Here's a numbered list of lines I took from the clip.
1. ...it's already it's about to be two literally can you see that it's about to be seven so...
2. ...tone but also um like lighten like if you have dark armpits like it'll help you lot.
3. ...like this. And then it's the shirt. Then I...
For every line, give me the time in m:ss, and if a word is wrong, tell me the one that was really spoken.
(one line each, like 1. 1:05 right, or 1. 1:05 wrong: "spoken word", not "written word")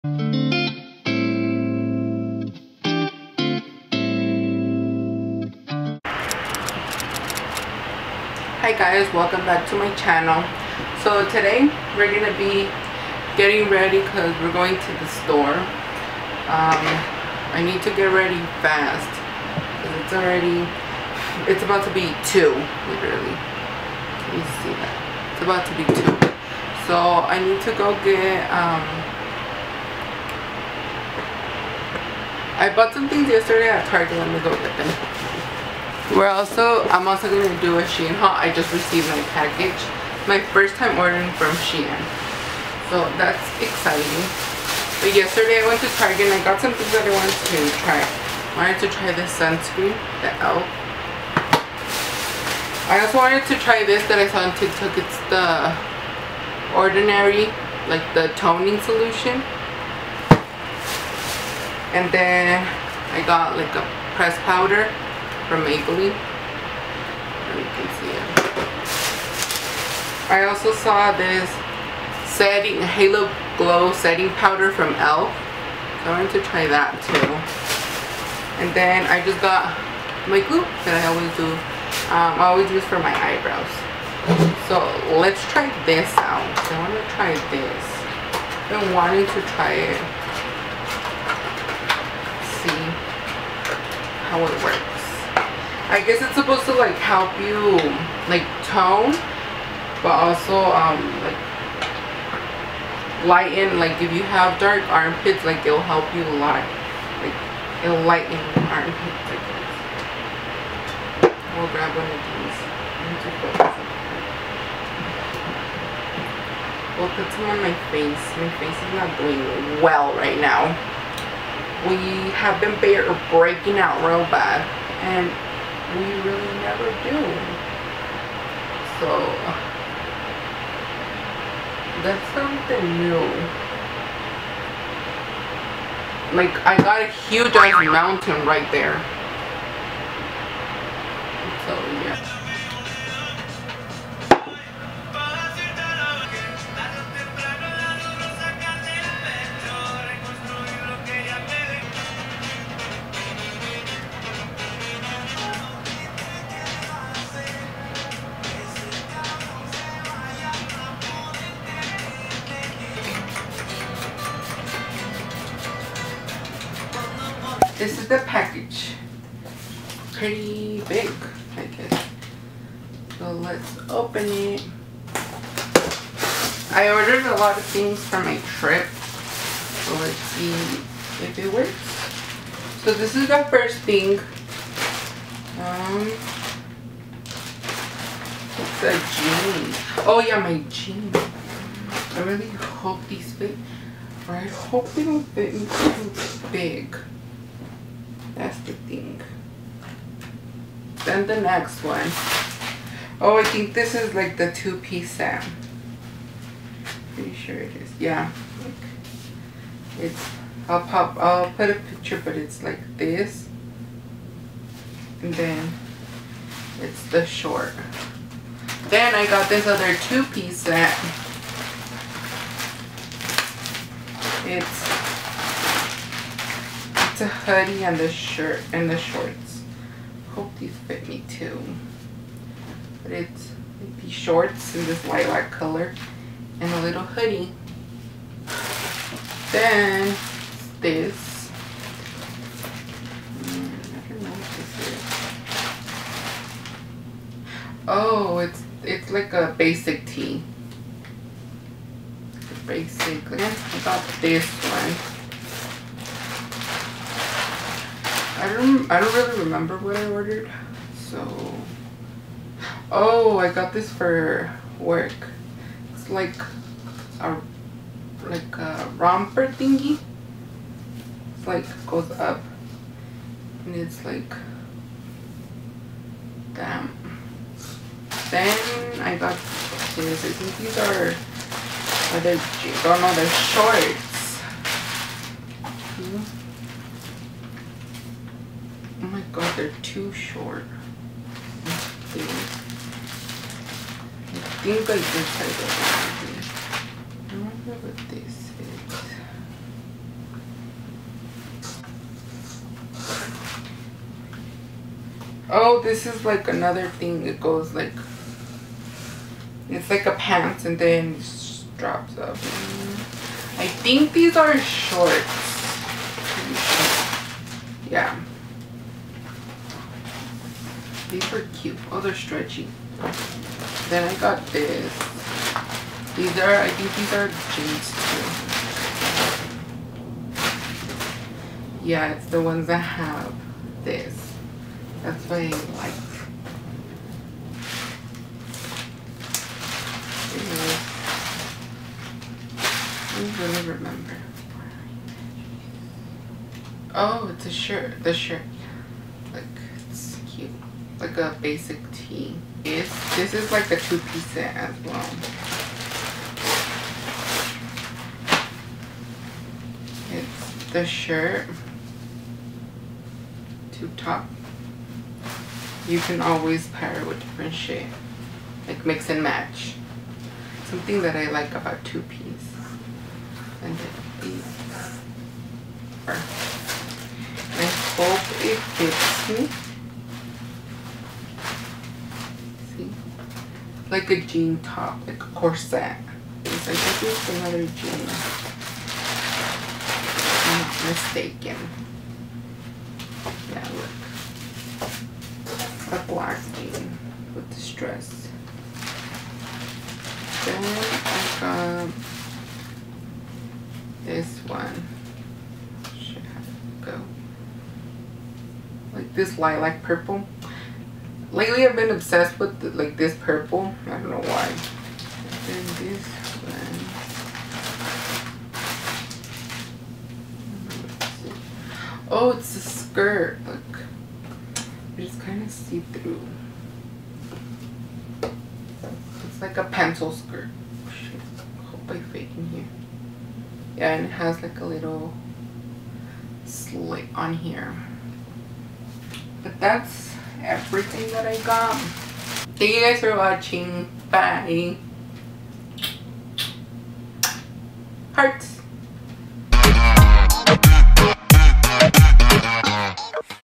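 1. 0:20 wrong: "two", not "seven"
2. 1:38 right
3. 3:32 wrong: "short", not "shirt".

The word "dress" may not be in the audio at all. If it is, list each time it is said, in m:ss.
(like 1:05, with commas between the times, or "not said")
6:37.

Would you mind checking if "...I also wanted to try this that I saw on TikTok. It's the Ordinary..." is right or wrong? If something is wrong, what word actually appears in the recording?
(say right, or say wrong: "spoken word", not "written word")
right.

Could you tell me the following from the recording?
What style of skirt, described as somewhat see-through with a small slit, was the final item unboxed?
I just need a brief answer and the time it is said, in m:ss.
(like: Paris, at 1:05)
Pencil skirt, at 7:09.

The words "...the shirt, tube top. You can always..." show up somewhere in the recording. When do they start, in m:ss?
6:00.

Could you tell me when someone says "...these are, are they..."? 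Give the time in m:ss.
4:40.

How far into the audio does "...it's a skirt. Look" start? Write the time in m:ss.
7:02.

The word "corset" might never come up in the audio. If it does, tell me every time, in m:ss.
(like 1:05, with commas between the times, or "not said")
6:25.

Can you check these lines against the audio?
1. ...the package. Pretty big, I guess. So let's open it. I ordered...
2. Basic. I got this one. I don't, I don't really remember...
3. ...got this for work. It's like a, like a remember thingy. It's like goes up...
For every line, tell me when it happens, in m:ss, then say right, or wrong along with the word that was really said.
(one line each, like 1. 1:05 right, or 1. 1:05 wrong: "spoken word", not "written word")
1. 2:48 right
2. 4:12 right
3. 4:23 wrong: "romper", not "remember".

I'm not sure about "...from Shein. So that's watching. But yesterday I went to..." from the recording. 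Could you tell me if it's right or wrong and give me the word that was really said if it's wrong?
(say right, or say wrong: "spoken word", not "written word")
wrong: "exciting", not "watching".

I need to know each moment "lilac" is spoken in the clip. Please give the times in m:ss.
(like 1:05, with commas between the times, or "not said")
3:55, 6:49.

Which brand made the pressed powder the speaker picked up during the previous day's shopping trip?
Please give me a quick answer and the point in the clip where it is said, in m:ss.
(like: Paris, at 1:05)
Maybelline, at 1:05.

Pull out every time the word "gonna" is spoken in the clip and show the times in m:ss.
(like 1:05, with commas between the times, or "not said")
0:12, 5:43.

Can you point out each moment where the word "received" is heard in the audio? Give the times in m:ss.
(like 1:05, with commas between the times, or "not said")
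0:38.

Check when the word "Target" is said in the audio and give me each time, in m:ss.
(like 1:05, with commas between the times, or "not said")
0:33, 0:45.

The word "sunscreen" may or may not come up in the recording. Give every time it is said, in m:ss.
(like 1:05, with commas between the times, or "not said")
0:49.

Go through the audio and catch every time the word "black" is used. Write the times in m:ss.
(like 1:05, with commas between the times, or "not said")
6:36.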